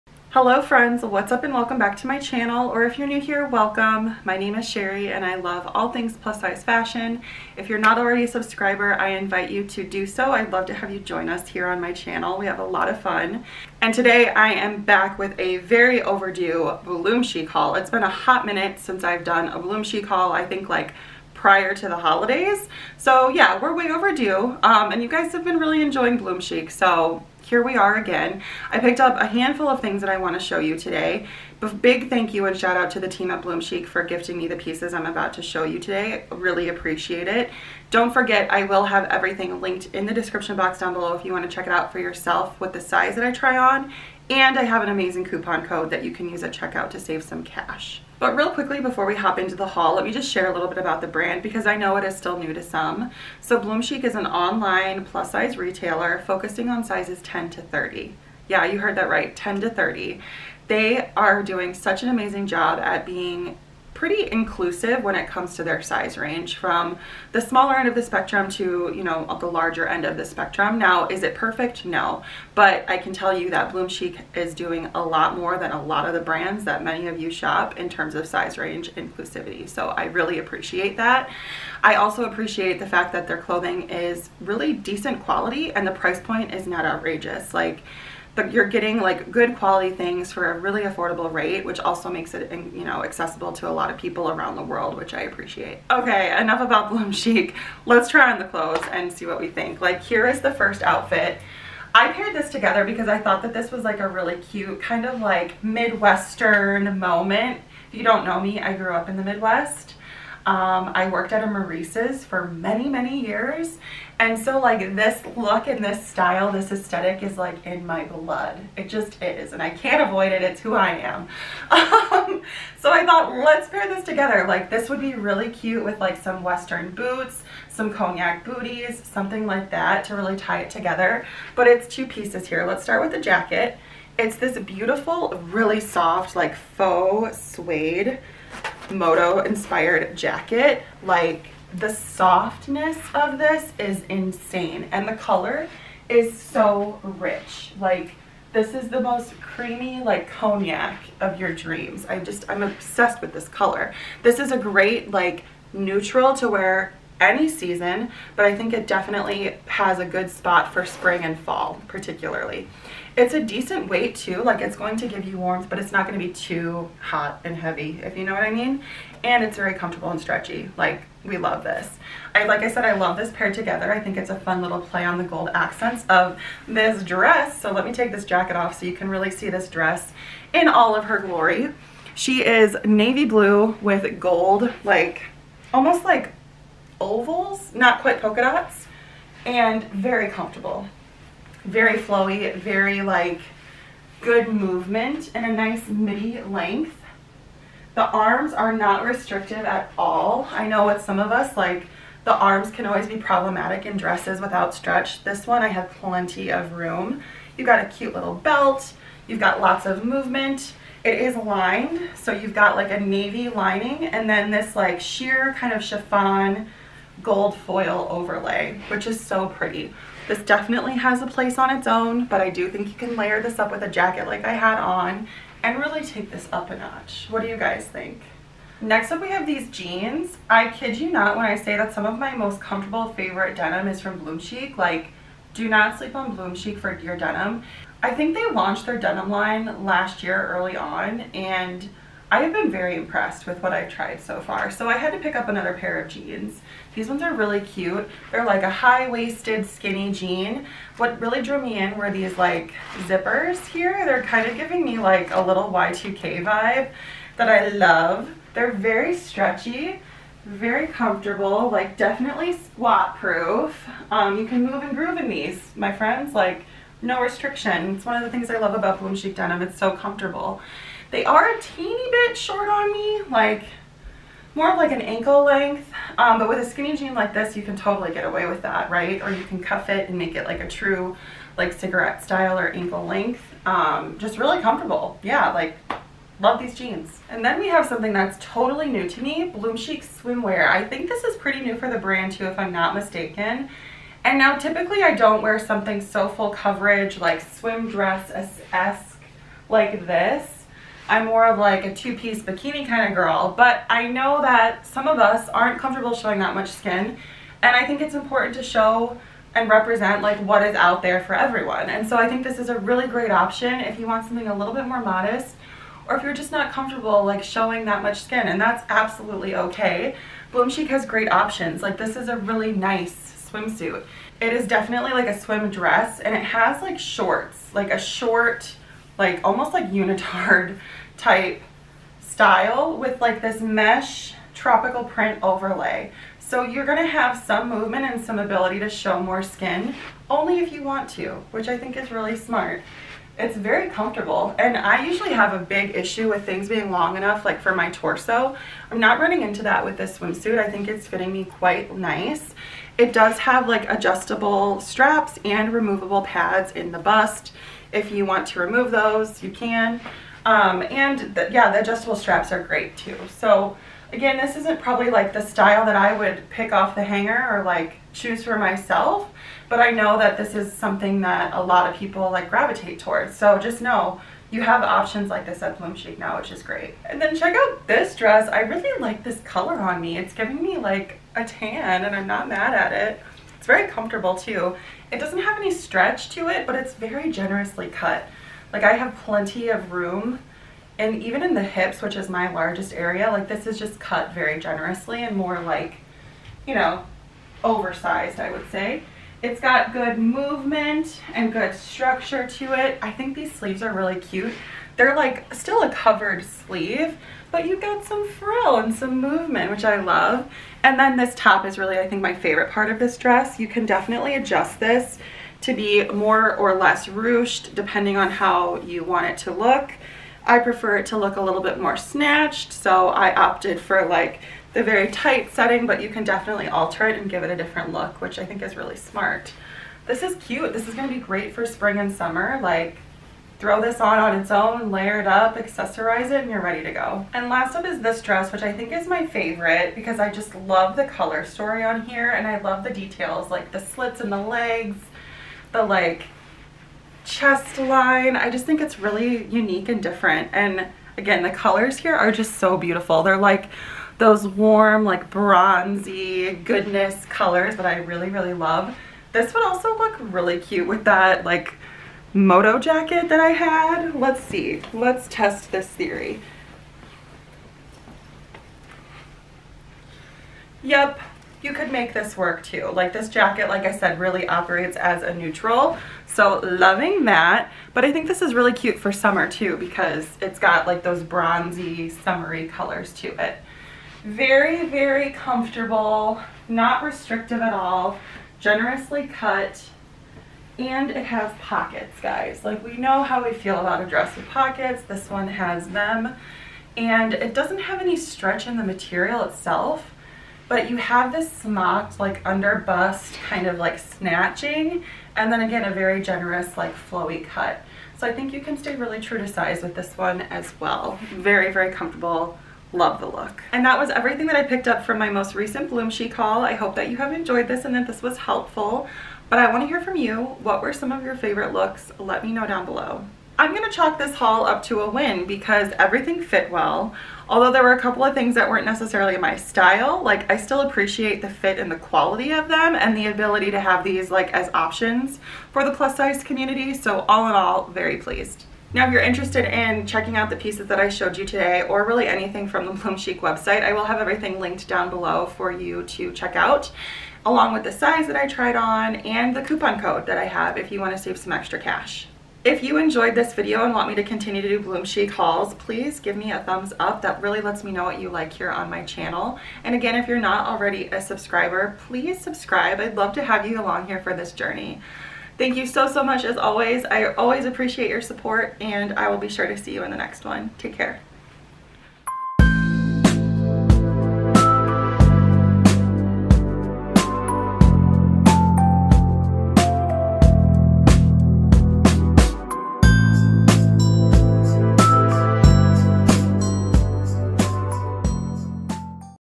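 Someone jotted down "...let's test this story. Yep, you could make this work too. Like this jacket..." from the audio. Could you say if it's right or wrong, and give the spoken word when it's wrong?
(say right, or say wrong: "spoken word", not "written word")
wrong: "theory", not "story".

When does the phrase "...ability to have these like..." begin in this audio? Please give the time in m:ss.
8:53.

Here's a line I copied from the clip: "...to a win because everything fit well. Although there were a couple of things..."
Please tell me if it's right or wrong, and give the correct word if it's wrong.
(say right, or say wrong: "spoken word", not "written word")
right.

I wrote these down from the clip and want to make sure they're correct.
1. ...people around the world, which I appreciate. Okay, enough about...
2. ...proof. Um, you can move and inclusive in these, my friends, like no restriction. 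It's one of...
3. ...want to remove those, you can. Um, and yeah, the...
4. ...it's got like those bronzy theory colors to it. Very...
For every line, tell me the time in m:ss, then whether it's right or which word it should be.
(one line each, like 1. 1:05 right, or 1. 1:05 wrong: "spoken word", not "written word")
1. 1:33 right
2. 4:23 wrong: "groove", not "inclusive"
3. 5:58 right
4. 8:00 wrong: "summery", not "theory".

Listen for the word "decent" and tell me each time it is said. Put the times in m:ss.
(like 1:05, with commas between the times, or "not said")
1:24, 2:43.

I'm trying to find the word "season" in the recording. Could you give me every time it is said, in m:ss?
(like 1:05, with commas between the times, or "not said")
2:37.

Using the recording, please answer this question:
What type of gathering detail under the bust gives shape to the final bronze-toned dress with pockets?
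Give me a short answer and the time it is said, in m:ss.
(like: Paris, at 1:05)
smocked, at 8:21.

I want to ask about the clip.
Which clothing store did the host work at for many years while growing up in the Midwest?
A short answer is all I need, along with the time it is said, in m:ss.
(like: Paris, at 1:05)
Maurice's, at 1:51.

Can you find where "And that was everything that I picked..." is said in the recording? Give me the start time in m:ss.
8:33.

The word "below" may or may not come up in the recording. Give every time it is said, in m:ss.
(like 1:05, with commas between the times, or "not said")
0:40, 8:42, 9:05.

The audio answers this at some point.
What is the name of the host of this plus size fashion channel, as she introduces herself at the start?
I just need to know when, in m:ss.
0:04.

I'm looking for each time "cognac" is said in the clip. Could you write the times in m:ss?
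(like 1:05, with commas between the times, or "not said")
2:07, 2:30.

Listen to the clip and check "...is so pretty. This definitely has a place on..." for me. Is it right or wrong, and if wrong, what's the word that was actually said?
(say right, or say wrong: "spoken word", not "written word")
right.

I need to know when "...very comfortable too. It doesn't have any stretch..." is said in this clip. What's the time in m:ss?
6:23.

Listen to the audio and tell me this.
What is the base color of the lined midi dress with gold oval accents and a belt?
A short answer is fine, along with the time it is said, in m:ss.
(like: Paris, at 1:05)
navy blue, at 3:02.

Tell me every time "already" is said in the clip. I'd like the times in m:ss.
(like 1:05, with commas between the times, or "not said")
0:07, 9:20.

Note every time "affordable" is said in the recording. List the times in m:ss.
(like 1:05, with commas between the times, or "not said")
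1:30.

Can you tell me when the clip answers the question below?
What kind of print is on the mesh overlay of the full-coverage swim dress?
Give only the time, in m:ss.
5:34.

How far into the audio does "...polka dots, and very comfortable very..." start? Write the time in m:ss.
3:08.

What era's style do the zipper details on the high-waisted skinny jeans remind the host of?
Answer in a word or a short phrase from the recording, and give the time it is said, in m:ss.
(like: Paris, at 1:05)
Y2K, at 4:15.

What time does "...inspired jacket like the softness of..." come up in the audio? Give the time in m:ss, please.
2:19.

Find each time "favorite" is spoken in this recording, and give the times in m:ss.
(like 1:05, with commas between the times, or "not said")
3:53, 6:52, 7:19, 8:41.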